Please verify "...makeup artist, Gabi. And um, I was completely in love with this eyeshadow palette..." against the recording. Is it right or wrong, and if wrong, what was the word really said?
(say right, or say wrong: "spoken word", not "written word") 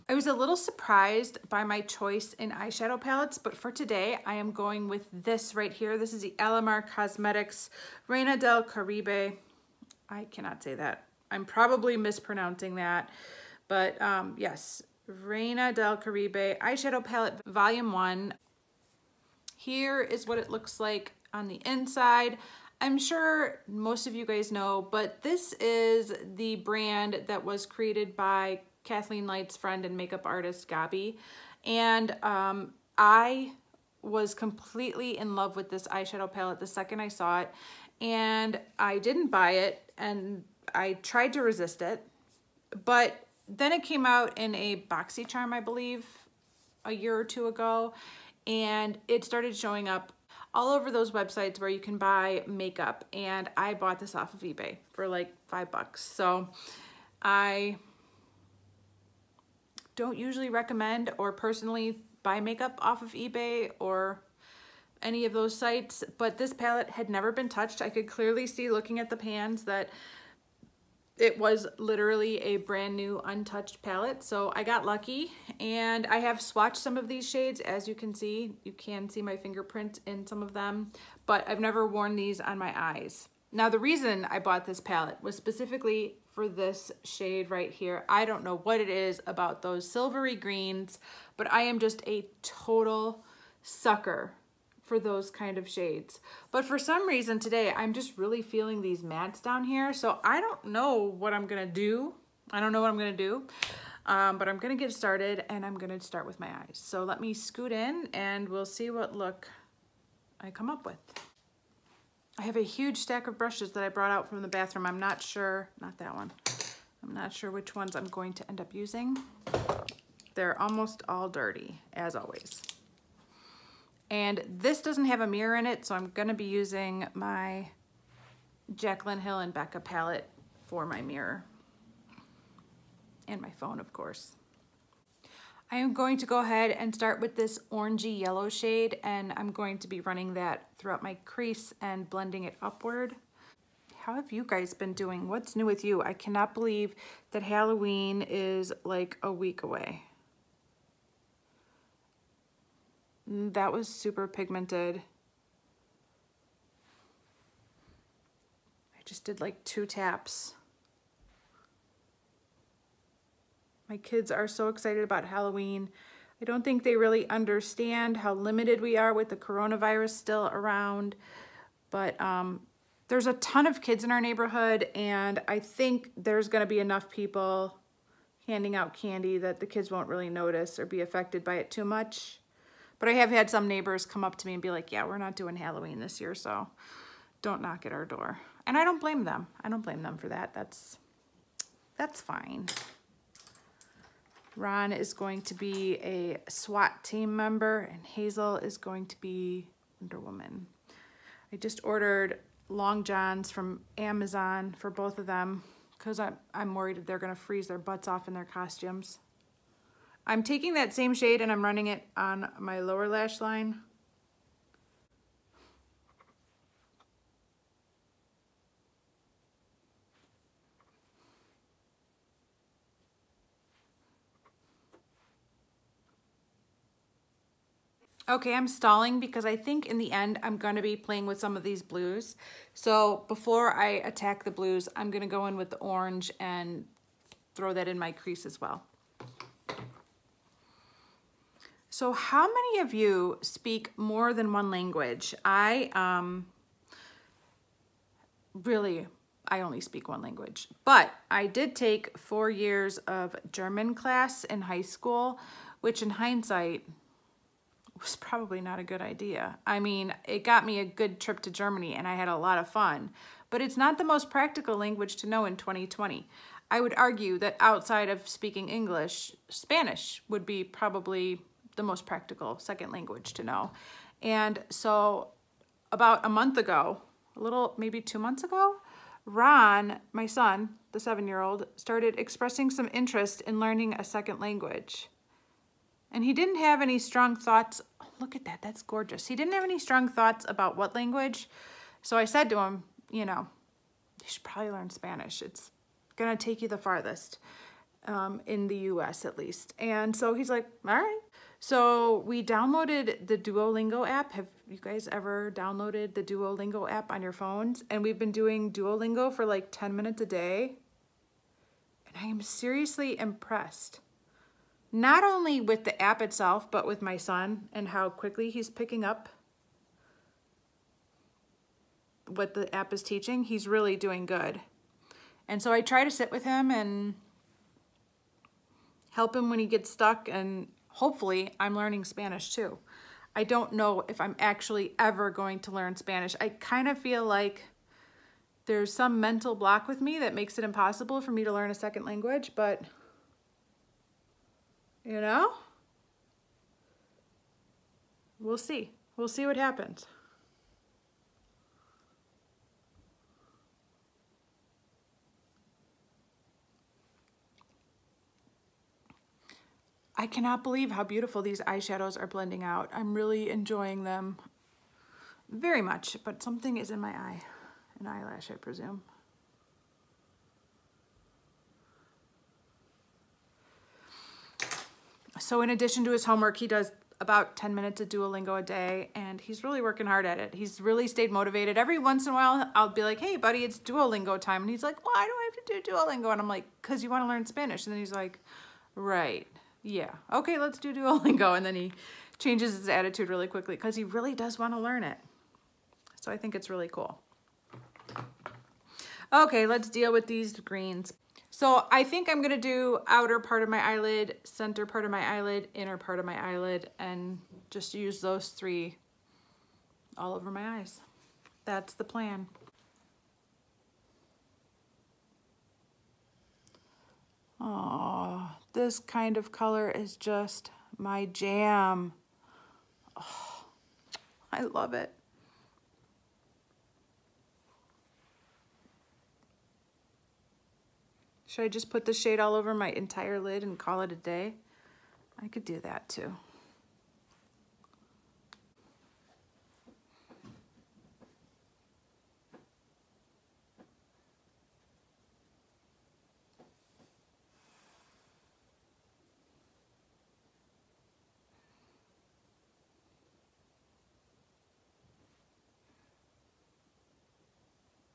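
right.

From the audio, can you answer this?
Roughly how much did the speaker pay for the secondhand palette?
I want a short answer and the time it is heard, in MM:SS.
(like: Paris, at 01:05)
5 dollars, at 00:55.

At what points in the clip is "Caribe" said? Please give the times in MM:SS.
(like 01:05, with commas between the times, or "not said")
00:08, 00:15.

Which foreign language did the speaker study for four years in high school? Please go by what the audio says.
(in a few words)
German.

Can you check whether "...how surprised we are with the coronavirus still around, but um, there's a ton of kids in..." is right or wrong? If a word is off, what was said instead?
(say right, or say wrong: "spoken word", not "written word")
wrong: "limited", not "surprised".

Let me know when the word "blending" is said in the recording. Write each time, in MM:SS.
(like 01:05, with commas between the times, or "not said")
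02:22, 06:02.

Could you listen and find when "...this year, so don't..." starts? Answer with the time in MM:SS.
03:05.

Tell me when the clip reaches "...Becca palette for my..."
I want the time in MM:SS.
02:09.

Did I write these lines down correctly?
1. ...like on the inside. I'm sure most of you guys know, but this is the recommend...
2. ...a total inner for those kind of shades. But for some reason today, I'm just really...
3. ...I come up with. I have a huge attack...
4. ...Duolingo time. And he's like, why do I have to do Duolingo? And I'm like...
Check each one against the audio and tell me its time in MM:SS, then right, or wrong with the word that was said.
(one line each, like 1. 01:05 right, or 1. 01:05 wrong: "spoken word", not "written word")
1. 00:20 wrong: "brand", not "recommend"
2. 01:32 wrong: "sucker", not "inner"
3. 01:50 wrong: "stack", not "attack"
4. 06:23 right.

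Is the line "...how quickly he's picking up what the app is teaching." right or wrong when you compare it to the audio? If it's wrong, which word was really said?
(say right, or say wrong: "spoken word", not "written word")
right.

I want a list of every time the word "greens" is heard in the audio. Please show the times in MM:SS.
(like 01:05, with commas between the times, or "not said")
01:30, 06:40.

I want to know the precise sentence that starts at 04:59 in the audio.
And so he's like, all right.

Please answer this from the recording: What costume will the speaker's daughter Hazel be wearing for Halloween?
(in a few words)
Wonder Woman.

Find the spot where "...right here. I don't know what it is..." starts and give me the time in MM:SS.
01:27.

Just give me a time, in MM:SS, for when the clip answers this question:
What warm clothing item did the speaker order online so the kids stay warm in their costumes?
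03:22.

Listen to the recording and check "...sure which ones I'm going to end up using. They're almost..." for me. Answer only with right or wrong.
right.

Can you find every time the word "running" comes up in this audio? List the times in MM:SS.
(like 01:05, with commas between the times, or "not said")
02:20, 03:31.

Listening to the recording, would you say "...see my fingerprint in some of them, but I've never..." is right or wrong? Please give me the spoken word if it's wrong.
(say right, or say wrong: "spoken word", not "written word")
right.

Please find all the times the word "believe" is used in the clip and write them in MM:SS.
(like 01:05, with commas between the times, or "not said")
00:45, 02:26, 06:00.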